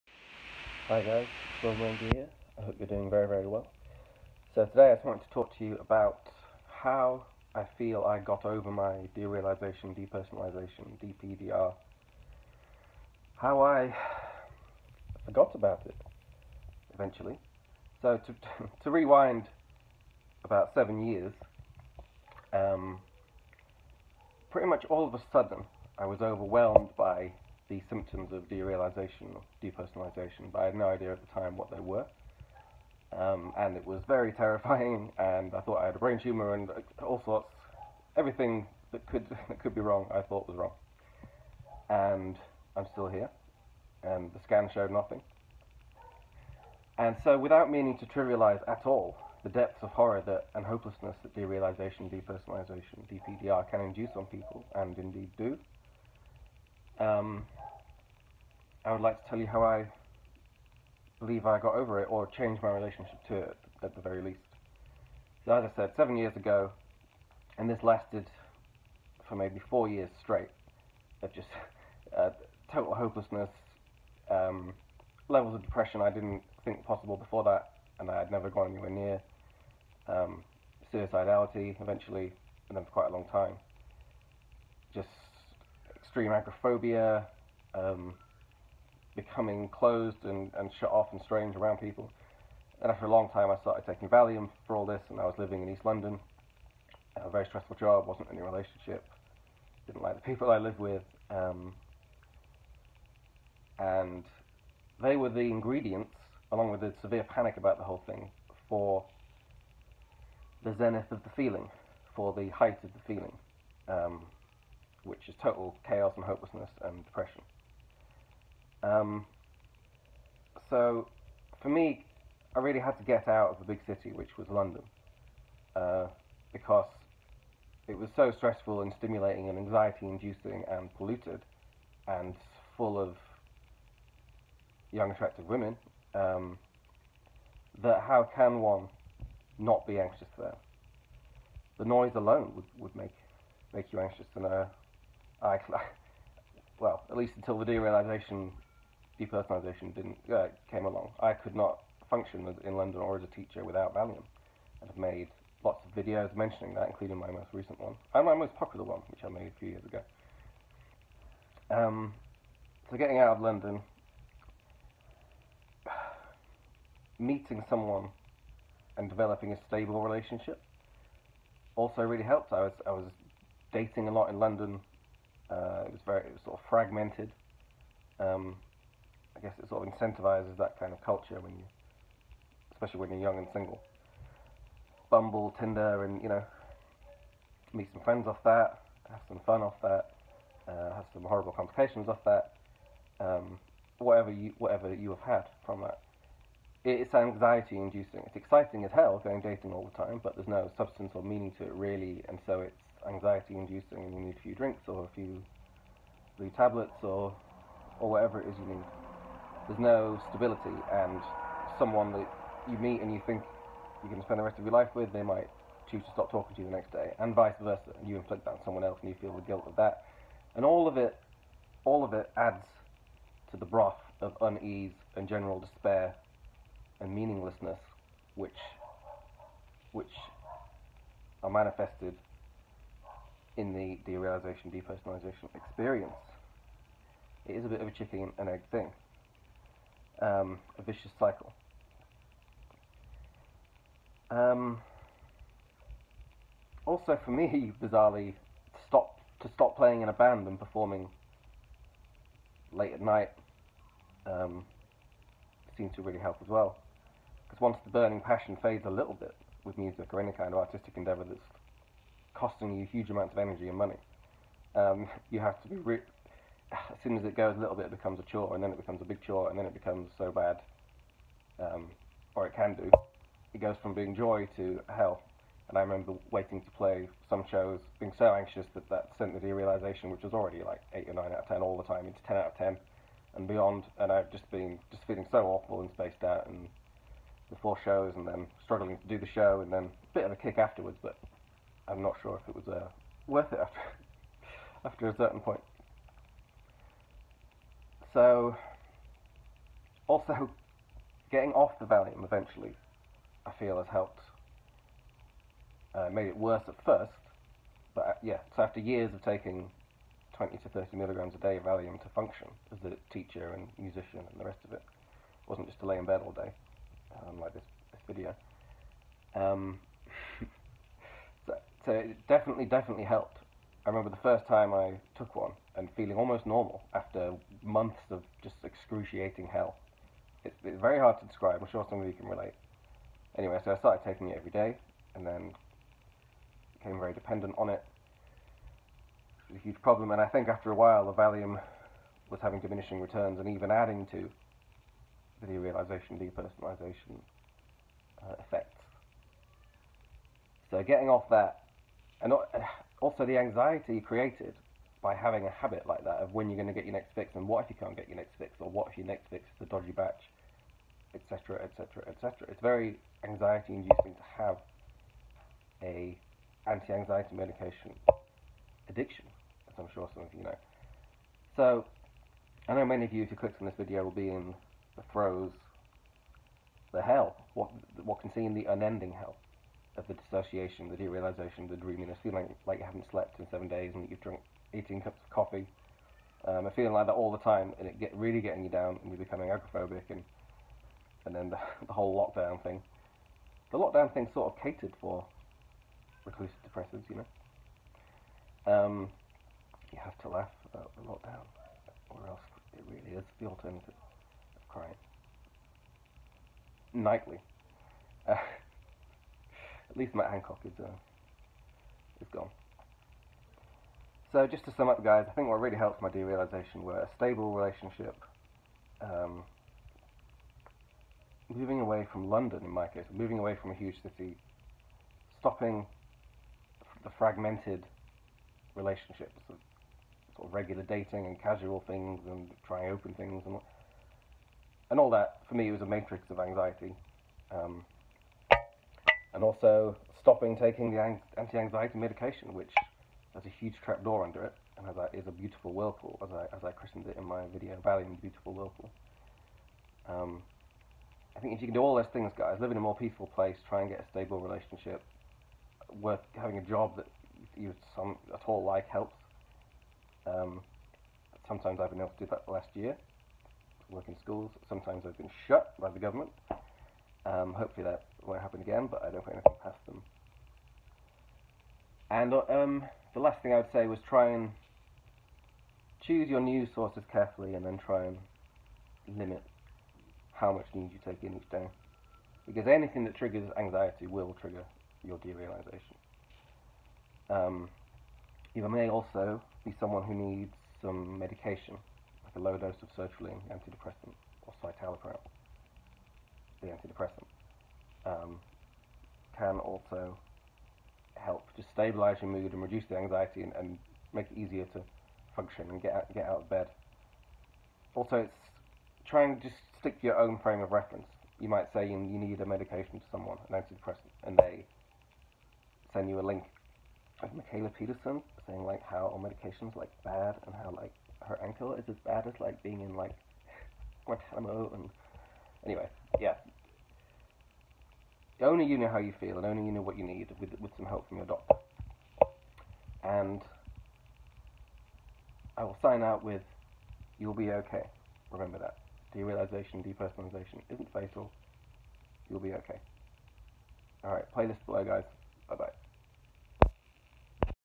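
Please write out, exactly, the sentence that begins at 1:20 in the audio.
Um, suicidality eventually, and then for quite a long time.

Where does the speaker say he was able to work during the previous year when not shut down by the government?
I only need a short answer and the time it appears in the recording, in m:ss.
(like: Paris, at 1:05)
schools, at 7:44.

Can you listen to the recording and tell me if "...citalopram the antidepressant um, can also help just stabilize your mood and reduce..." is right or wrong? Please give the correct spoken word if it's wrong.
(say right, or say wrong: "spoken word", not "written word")
right.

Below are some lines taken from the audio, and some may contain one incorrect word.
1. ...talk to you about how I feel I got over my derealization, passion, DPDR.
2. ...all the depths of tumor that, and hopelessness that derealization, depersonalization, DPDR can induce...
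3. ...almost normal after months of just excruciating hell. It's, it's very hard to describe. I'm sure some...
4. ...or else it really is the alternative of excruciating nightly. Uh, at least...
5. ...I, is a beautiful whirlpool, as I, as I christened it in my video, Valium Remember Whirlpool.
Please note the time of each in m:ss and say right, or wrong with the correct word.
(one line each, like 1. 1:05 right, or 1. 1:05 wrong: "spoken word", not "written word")
1. 0:05 wrong: "depersonalization", not "passion"
2. 0:48 wrong: "horror", not "tumor"
3. 5:26 right
4. 6:42 wrong: "crying", not "excruciating"
5. 7:24 wrong: "Beautiful", not "Remember".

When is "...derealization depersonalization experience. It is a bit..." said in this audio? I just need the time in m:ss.
3:54.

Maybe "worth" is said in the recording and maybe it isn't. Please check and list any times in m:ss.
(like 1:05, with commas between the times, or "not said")
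4:53, 7:36.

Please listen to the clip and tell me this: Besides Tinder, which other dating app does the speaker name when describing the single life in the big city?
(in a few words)
Bumble.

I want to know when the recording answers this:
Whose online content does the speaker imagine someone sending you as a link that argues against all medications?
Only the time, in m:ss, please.
8:37.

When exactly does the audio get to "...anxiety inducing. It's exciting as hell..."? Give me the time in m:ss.
3:17.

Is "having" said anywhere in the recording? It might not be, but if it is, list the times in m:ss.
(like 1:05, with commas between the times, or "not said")
5:42, 5:55, 7:36.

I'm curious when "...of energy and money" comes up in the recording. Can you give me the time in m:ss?
4:23.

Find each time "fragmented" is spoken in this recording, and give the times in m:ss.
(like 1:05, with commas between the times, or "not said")
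2:56, 7:07.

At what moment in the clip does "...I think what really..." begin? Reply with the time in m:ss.
6:55.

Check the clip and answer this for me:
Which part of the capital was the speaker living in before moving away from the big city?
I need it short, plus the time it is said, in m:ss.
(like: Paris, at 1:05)
East London, at 1:35.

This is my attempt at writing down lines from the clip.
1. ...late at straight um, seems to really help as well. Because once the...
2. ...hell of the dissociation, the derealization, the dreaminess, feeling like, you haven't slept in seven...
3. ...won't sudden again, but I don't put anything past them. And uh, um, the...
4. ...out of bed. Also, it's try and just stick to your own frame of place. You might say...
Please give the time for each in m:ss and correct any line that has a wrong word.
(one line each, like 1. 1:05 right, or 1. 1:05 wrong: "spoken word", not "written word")
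1. 4:12 wrong: "night", not "straight"
2. 6:19 right
3. 7:48 wrong: "happen", not "sudden"
4. 8:26 wrong: "reference", not "place".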